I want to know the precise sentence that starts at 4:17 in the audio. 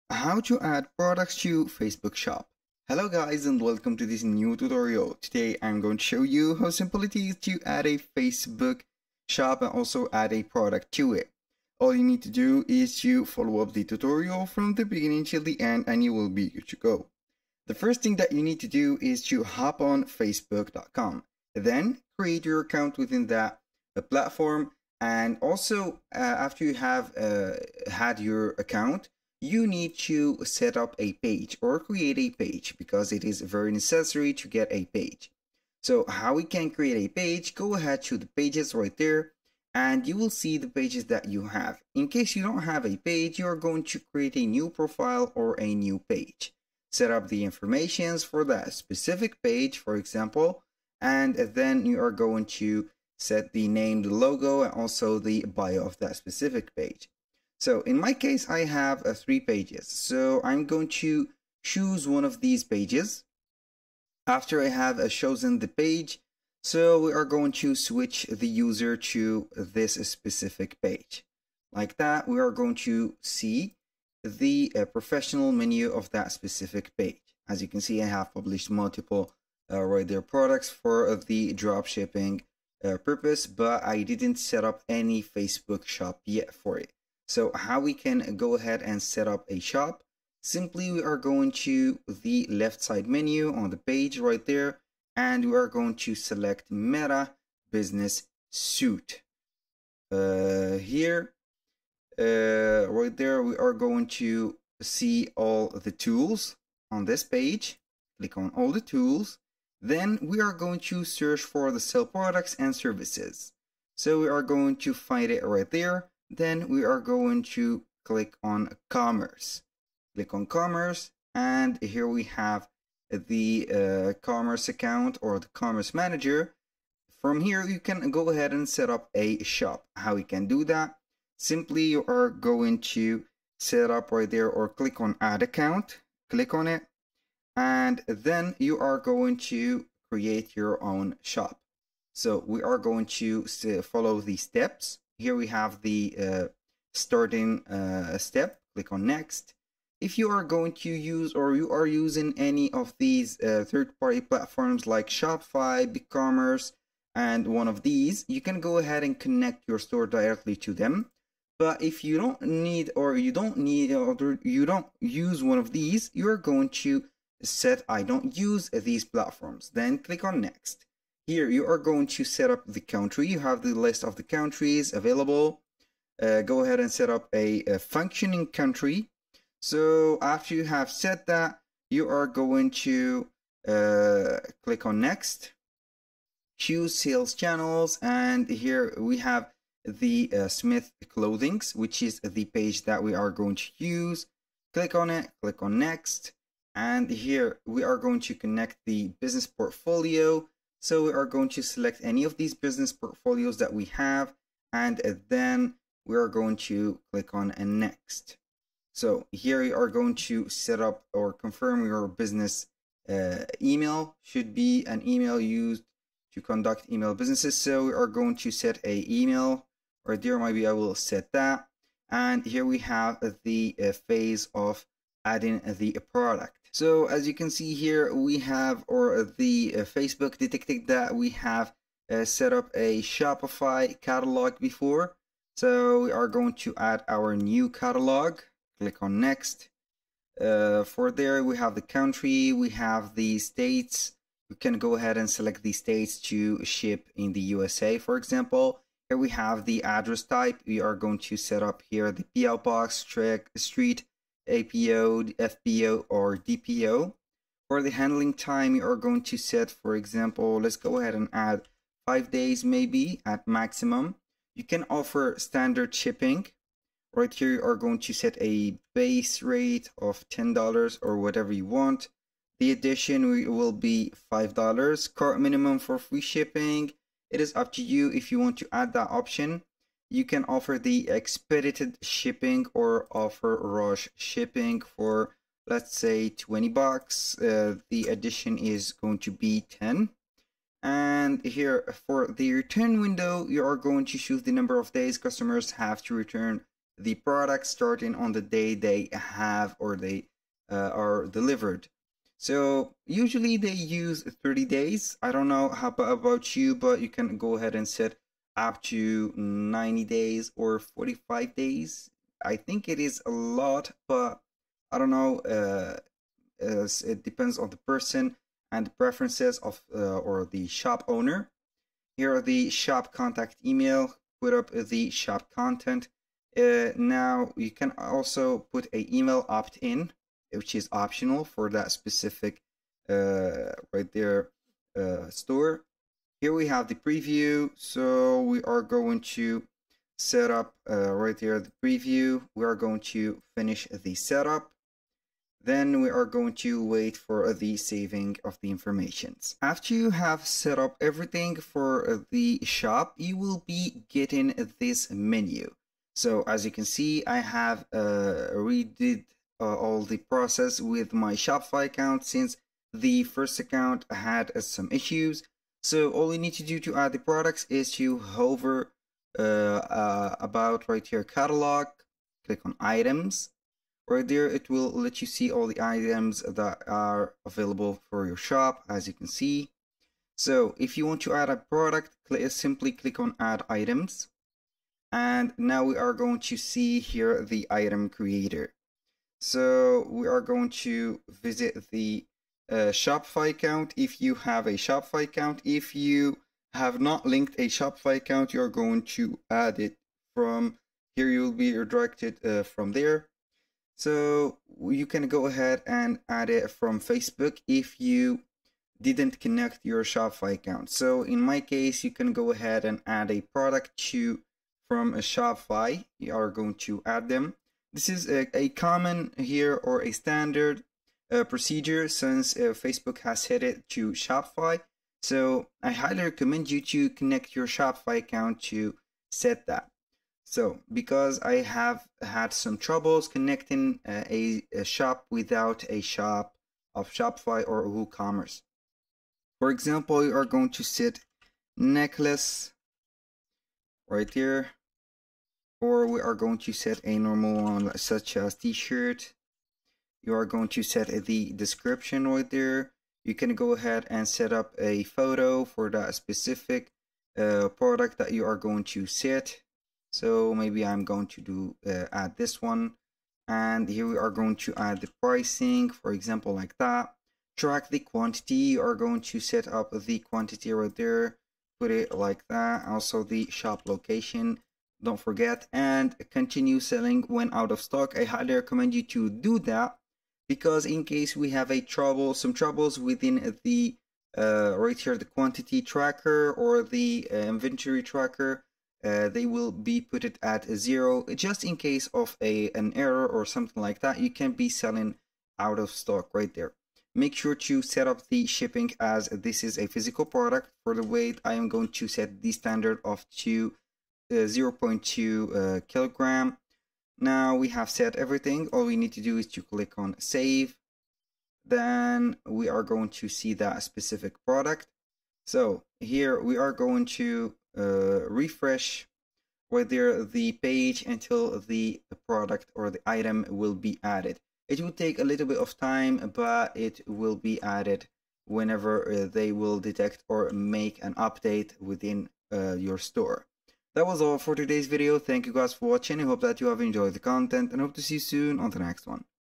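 For the handling time, you are going to set, for example, let's go ahead and add five days maybe at maximum.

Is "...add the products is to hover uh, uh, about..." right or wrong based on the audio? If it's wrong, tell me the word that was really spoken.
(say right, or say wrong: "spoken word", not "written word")
right.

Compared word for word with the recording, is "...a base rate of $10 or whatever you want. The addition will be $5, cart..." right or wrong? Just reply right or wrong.
right.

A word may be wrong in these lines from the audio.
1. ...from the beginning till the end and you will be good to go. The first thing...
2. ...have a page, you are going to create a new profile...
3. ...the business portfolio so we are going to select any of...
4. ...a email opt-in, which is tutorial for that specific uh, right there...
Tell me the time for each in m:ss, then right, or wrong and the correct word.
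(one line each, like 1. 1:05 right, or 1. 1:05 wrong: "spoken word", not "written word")
1. 0:14 right
2. 0:42 right
3. 3:18 right
4. 5:28 wrong: "optional", not "tutorial".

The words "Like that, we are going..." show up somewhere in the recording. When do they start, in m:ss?
1:11.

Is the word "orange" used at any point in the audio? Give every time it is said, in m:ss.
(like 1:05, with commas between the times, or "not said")
not said.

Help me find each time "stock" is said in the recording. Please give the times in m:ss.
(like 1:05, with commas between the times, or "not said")
7:57, 8:15.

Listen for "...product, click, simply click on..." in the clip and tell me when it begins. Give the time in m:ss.
6:21.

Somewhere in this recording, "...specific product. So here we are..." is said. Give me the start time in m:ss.
8:33.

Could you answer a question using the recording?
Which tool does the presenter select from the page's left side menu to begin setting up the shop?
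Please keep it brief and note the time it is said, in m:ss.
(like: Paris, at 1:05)
Meta Business Suite, at 1:36.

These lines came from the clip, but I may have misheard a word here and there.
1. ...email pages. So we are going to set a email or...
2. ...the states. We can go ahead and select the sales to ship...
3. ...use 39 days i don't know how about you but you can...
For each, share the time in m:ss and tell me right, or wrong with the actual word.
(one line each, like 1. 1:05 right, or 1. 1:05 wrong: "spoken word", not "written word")
1. 3:36 wrong: "businesses", not "pages"
2. 4:03 wrong: "states", not "sales"
3. 5:03 wrong: "30", not "39".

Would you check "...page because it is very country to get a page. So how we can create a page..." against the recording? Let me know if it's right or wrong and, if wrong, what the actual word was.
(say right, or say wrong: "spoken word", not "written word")
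wrong: "necessary", not "country".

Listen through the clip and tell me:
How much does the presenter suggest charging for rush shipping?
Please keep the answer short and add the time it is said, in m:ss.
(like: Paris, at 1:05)
$20, at 4:46.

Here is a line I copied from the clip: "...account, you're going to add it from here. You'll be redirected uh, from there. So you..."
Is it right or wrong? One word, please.
right.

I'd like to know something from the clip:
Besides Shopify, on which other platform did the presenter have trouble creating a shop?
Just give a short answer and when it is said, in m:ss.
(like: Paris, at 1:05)
WooCommerce, at 7:17.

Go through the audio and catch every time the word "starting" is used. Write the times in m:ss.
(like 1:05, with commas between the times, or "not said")
2:26, 4:57.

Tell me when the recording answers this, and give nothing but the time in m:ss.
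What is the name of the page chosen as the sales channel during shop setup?
3:10.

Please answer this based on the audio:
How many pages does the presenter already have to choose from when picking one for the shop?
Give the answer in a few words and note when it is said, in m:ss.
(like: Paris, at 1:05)
3, at 0:59.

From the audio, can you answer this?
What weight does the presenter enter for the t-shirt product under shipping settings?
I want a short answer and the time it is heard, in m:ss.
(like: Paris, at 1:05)
0.2 kg, at 8:24.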